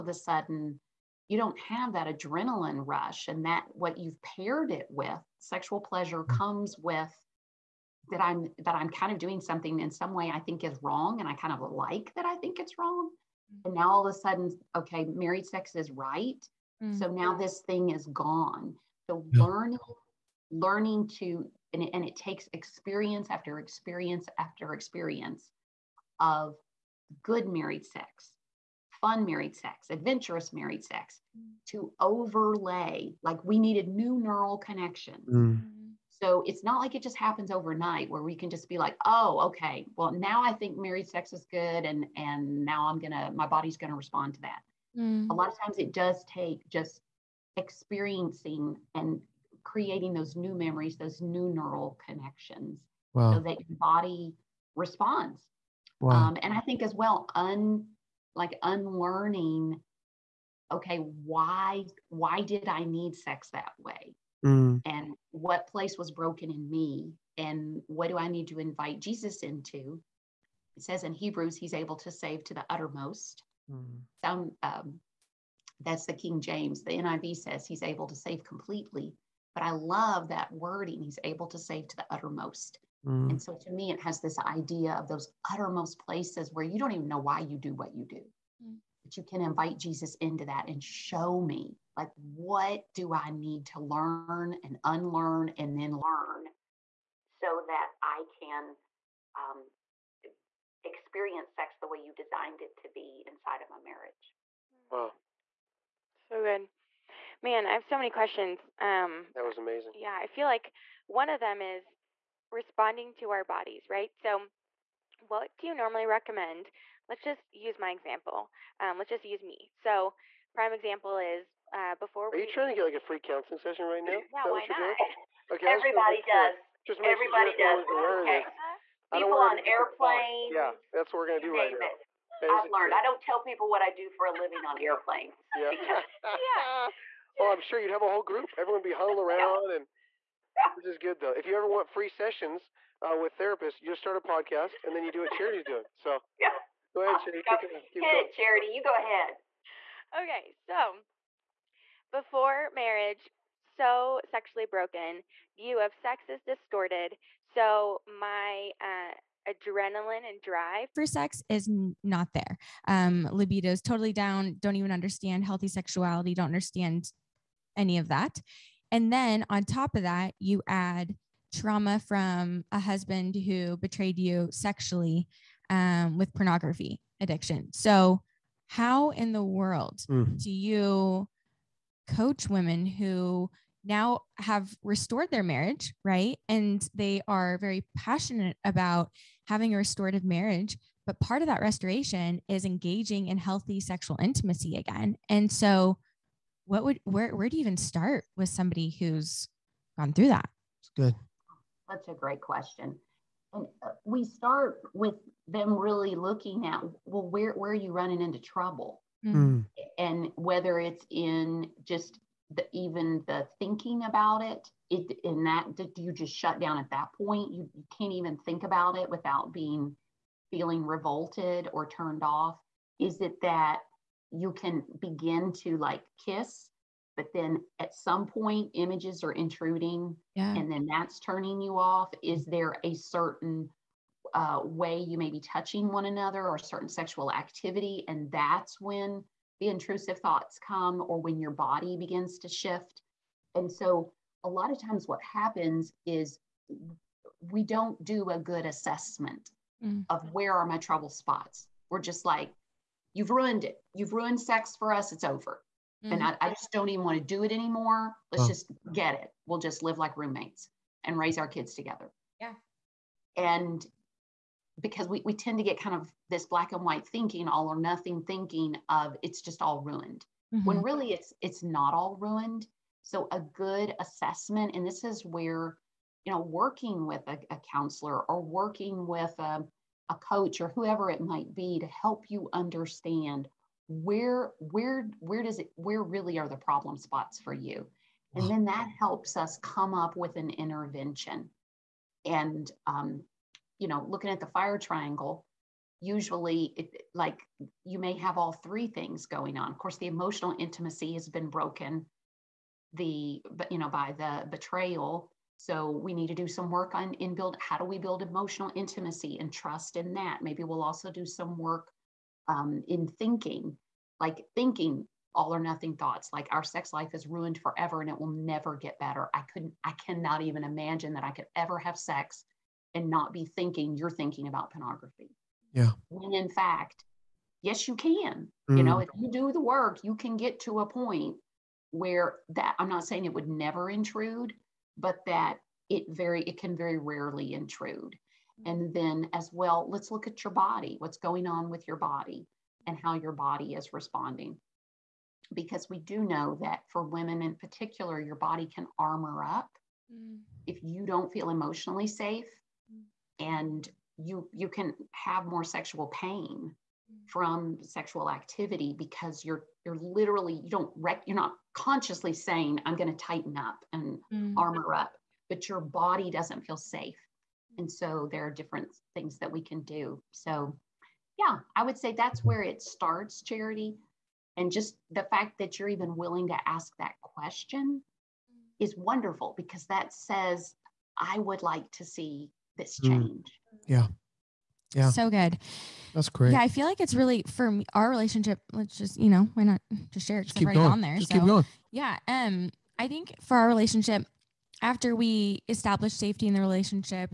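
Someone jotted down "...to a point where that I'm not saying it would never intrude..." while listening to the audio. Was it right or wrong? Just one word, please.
right.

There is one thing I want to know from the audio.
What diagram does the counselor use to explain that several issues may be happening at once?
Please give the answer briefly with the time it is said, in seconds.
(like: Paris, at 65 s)
The fire triangle, at 294 s.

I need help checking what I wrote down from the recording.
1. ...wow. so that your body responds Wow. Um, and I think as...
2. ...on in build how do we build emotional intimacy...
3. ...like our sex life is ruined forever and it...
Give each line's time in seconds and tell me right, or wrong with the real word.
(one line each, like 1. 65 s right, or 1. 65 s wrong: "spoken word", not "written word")
1. 53 s right
2. 306 s right
3. 316 s right.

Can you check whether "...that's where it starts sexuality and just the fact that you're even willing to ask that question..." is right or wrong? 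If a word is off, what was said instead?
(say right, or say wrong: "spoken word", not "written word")
wrong: "charity", not "sexuality".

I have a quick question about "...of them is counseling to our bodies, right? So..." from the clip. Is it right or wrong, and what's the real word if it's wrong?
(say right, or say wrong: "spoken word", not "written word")
wrong: "responding", not "counseling".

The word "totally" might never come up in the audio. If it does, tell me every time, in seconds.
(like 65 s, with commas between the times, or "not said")
163 s.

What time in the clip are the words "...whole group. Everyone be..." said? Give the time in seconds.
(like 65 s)
138 s.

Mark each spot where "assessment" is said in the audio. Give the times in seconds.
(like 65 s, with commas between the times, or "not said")
248 s, 273 s.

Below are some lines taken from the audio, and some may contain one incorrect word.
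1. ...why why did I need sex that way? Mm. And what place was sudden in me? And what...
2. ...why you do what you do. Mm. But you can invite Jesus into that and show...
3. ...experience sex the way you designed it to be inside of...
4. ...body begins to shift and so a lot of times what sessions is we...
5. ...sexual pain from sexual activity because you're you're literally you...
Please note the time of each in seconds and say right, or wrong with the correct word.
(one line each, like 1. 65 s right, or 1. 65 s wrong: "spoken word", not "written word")
1. 60 s wrong: "broken", not "sudden"
2. 87 s right
3. 100 s right
4. 241 s wrong: "happens", not "sessions"
5. 355 s right.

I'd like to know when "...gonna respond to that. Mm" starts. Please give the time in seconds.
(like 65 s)
43 s.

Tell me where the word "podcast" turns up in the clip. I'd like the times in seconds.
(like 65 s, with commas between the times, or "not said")
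144 s.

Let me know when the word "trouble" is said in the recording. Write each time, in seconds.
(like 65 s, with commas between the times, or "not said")
208 s, 250 s.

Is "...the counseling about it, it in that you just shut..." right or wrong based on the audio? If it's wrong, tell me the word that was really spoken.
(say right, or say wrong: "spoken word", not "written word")
wrong: "thinking", not "counseling".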